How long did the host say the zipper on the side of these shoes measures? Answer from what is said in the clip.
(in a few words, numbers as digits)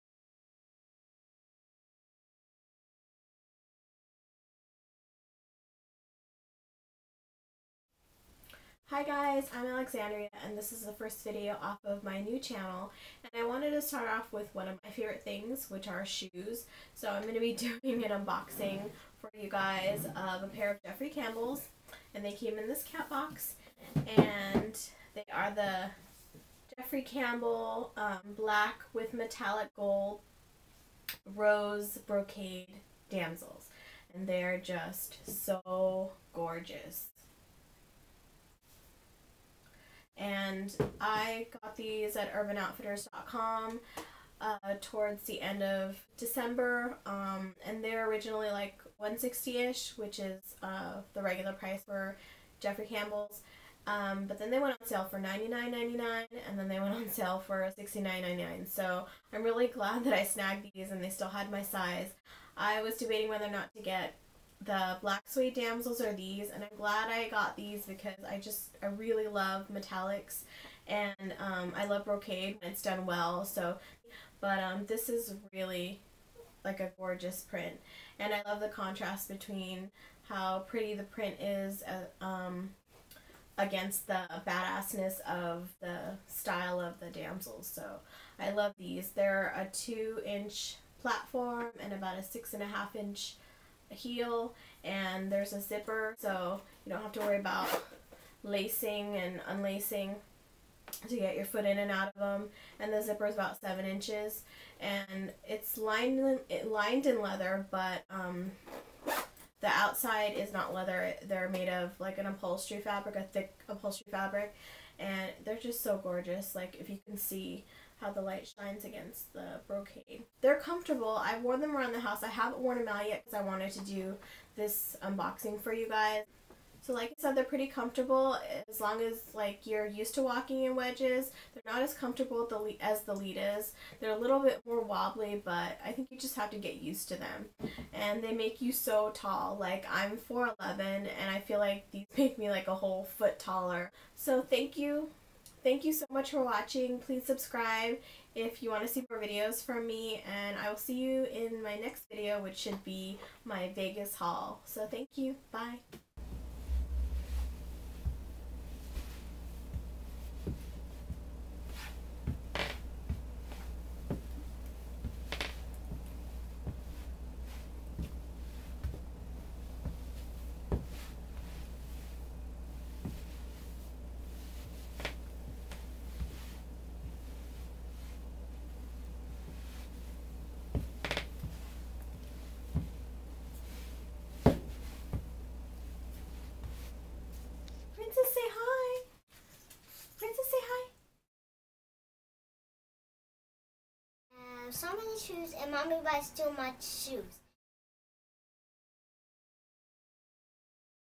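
7 inches.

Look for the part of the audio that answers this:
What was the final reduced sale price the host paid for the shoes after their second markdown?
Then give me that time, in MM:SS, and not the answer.
00:57.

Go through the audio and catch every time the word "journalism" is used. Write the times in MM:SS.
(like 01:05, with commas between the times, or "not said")
not said.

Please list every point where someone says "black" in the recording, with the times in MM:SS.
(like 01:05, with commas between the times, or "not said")
00:28, 01:05.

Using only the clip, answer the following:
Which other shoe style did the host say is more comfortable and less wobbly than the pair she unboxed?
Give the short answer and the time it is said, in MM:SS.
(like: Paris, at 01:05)
Litas, at 02:13.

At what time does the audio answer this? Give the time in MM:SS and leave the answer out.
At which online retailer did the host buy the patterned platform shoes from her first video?
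00:42.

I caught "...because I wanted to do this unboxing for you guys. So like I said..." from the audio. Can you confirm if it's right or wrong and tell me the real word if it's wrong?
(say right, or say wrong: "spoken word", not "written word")
right.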